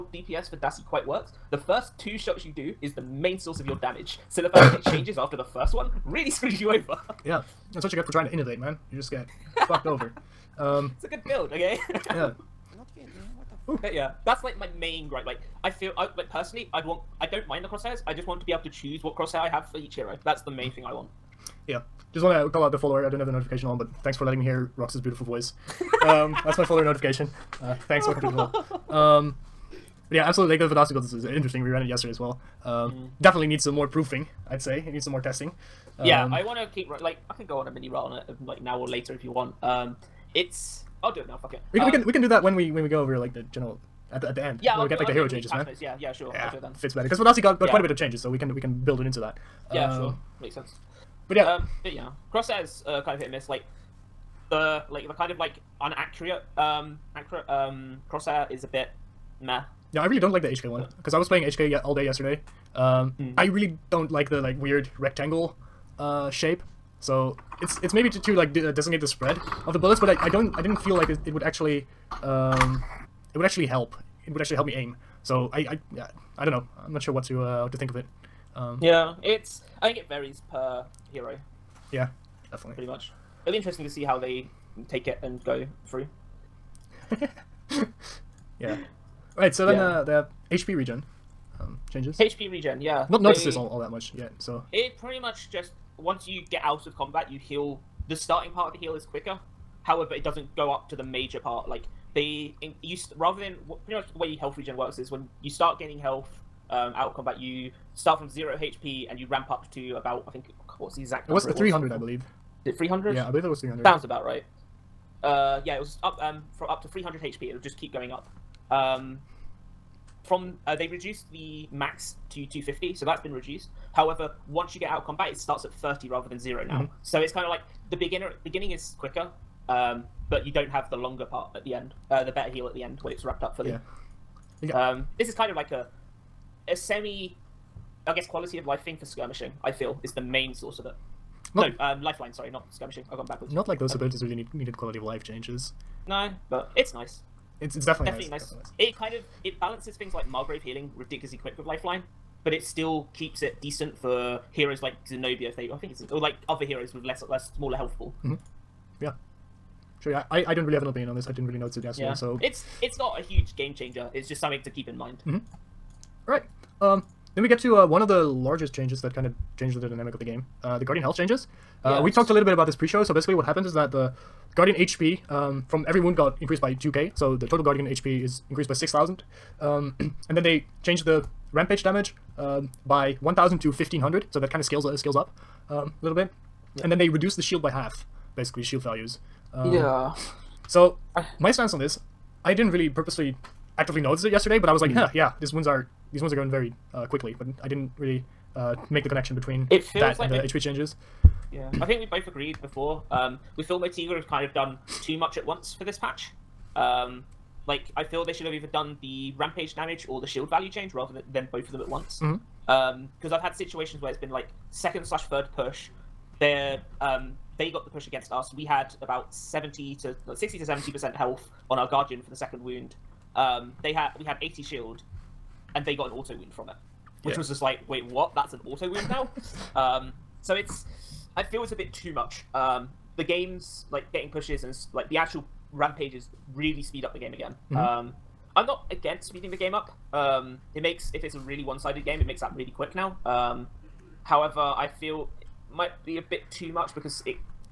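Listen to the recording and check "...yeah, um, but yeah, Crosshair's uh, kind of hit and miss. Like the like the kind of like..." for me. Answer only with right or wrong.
right.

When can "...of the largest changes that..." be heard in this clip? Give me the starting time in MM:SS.
02:47.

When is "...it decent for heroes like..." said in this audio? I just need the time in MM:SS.
02:33.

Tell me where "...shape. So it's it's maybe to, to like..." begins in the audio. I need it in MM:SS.
01:06.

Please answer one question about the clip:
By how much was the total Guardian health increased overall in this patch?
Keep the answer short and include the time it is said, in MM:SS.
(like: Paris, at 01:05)
6,000, at 02:58.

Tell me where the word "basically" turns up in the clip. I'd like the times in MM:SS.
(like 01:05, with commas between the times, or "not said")
02:53, 03:08.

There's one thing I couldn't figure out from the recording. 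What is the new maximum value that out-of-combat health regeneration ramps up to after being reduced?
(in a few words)
250.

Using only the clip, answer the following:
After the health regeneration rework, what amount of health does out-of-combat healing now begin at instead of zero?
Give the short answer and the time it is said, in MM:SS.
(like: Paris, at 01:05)
30, at 02:05.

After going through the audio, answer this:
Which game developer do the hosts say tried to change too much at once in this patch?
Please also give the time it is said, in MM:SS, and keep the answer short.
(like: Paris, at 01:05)
Motiga, at 03:23.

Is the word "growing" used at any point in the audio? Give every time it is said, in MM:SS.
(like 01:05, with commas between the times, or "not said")
not said.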